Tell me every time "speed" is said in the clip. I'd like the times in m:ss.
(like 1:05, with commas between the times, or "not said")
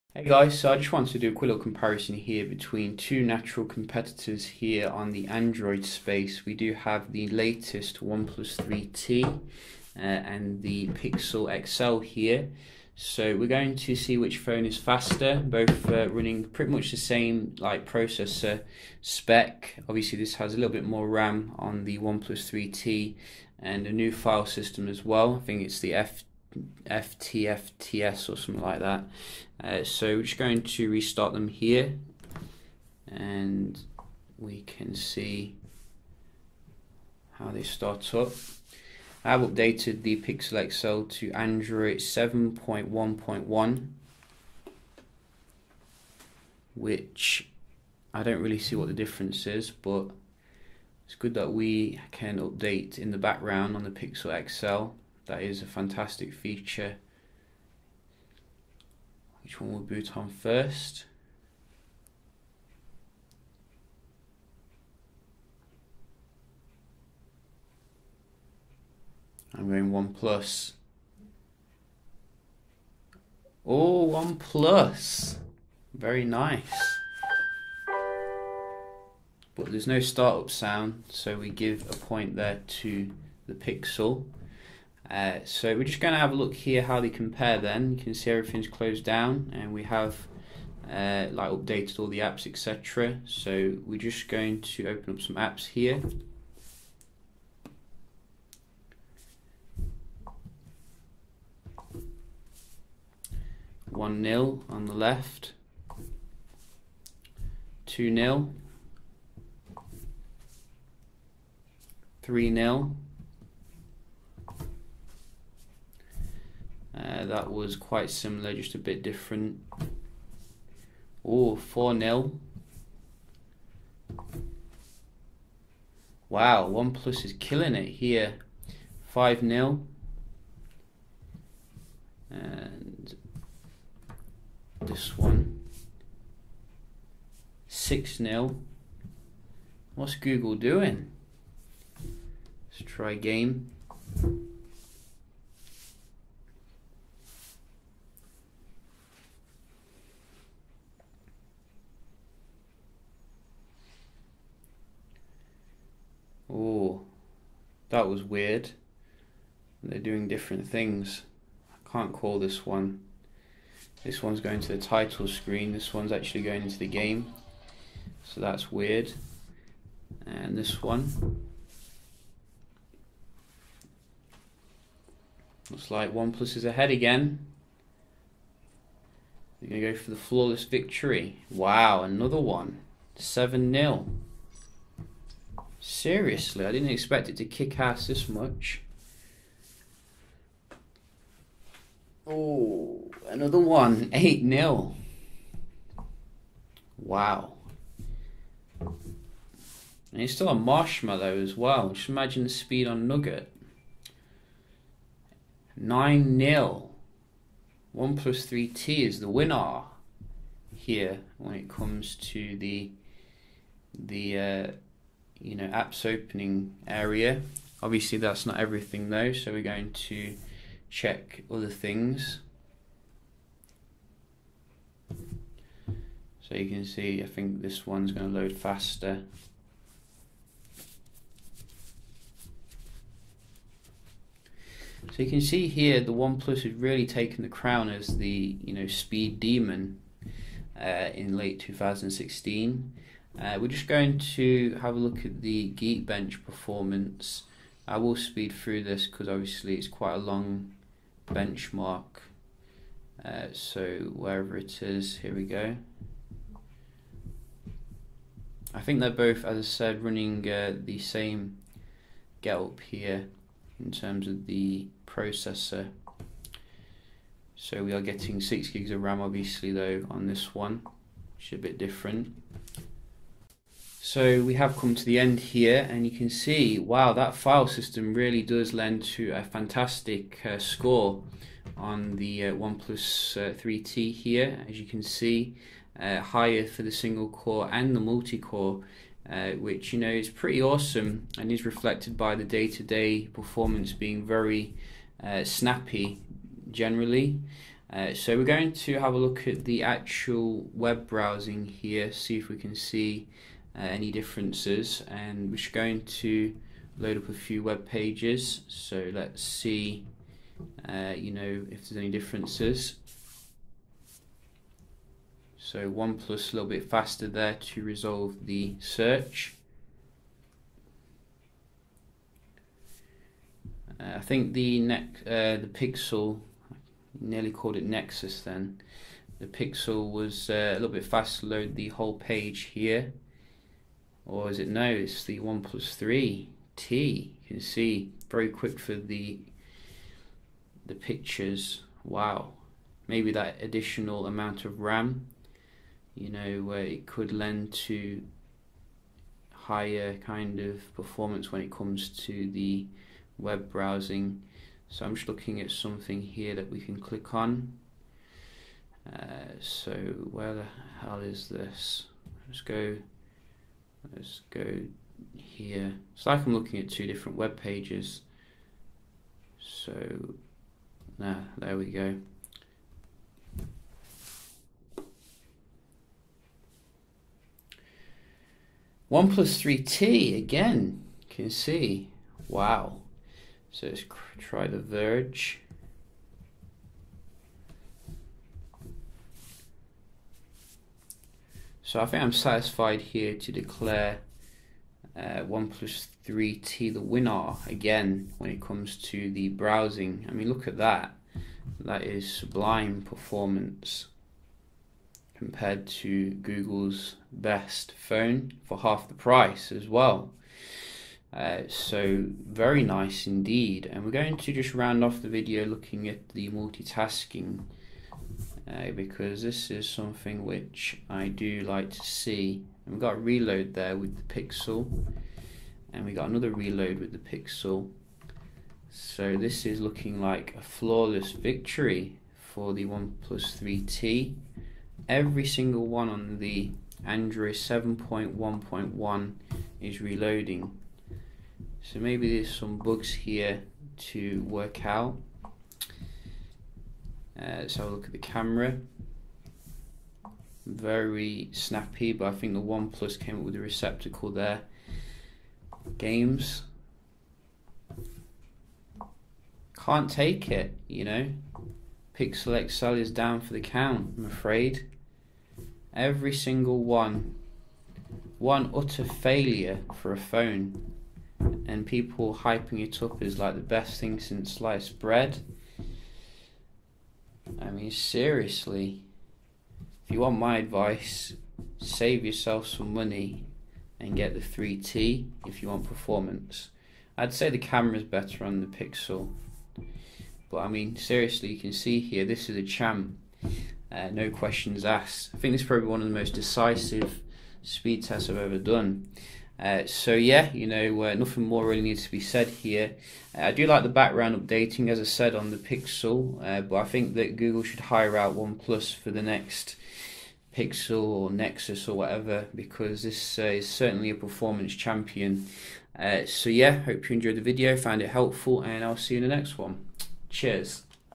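3:22, 3:58, 4:08, 8:17.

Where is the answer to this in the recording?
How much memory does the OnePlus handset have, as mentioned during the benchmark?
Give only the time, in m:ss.
4:28.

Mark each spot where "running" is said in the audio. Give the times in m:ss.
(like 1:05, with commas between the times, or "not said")
0:16, 4:20.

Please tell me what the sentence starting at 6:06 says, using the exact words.
It's like I'm looking at two different web pages.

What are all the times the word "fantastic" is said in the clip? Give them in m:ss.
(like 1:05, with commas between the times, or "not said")
0:55, 4:39.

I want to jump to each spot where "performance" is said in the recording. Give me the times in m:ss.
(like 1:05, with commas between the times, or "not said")
4:06, 4:53, 5:50, 6:43, 8:05, 8:34.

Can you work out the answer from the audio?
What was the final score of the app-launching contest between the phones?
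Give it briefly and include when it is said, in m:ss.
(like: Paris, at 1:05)
9 0, at 3:25.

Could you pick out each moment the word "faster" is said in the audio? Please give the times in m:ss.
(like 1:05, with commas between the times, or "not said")
0:14, 3:48, 5:16, 5:31.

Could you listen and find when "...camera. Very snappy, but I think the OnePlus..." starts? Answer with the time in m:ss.
7:28.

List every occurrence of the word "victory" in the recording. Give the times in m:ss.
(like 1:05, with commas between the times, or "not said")
3:00, 7:11.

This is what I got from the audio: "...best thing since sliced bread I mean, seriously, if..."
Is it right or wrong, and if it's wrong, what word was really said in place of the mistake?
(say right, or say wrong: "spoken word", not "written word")
right.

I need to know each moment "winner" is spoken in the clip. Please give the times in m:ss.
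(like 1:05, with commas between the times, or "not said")
3:29, 6:37.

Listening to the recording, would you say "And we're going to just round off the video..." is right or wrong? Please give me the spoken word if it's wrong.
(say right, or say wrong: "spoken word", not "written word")
right.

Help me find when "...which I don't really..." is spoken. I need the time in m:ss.
0:46.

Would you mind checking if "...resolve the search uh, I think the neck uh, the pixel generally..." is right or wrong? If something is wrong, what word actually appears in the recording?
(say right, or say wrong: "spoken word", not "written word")
wrong: "nearly", not "generally".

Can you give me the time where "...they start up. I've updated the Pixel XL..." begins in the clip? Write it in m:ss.
0:37.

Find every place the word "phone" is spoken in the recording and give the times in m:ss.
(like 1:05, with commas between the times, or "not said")
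0:14, 6:48, 7:50.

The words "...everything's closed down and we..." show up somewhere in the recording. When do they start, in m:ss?
1:28.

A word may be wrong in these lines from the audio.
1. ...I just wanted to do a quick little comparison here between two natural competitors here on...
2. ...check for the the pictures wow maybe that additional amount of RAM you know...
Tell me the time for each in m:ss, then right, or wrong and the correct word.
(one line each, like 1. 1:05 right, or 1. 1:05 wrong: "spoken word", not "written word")
1. 0:00 right
2. 5:38 wrong: "quick", not "check".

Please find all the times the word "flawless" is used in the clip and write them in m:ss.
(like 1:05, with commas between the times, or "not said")
3:00, 7:10.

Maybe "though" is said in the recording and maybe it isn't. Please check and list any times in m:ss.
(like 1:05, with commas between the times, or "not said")
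3:39, 4:29.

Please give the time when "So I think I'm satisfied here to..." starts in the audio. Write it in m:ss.
6:31.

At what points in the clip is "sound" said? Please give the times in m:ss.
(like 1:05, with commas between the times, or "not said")
1:20.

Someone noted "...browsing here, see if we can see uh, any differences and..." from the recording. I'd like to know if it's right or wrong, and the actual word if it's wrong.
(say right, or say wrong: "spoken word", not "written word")
right.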